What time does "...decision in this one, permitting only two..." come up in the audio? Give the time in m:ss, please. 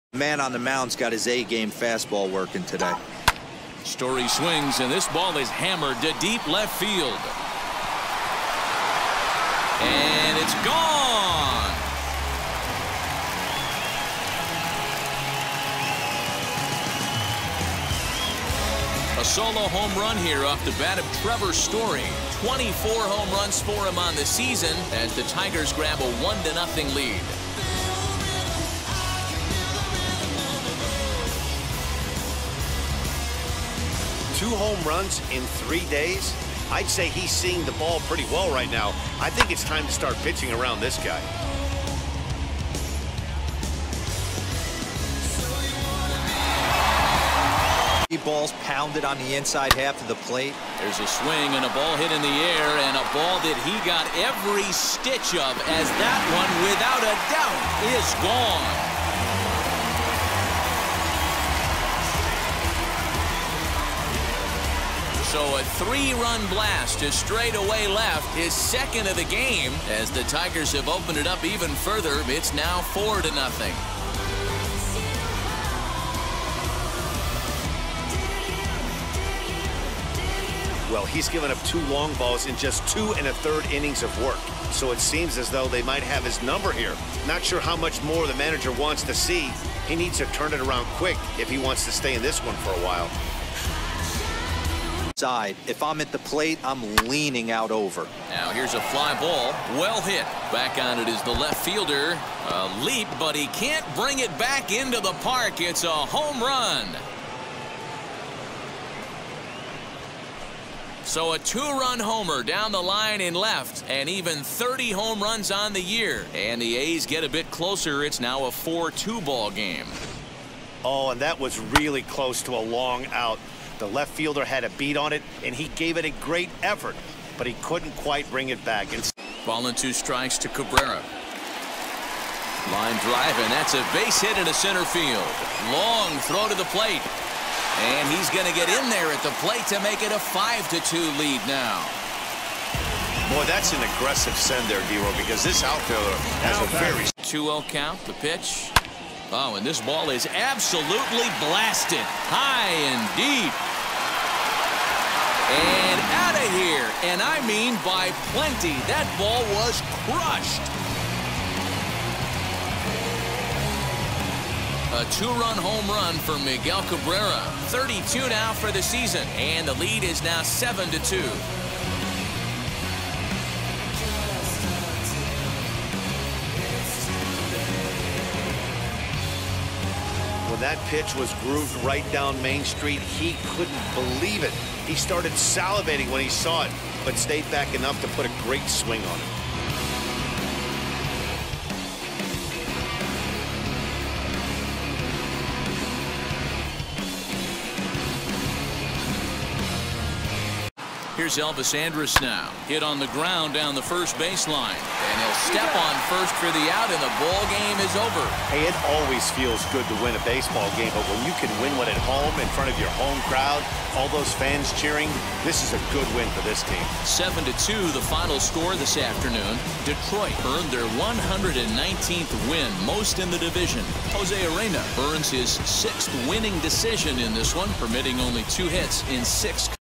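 3:46.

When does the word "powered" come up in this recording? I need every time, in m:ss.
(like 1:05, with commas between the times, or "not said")
not said.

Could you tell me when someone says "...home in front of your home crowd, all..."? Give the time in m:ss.
3:32.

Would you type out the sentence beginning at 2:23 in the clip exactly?
Boy, that's an aggressive send there, Dero, because this outfielder has a very...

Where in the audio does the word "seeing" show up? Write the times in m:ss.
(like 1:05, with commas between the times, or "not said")
0:37.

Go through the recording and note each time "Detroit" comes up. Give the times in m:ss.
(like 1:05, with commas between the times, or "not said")
3:39.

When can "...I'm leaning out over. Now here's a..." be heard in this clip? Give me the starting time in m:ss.
1:36.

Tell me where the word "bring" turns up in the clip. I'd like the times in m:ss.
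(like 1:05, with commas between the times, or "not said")
1:43, 2:08.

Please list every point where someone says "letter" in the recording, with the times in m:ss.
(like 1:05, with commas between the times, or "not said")
not said.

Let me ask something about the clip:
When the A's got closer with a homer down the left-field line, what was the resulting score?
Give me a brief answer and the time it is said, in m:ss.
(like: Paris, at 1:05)
4-2, at 1:58.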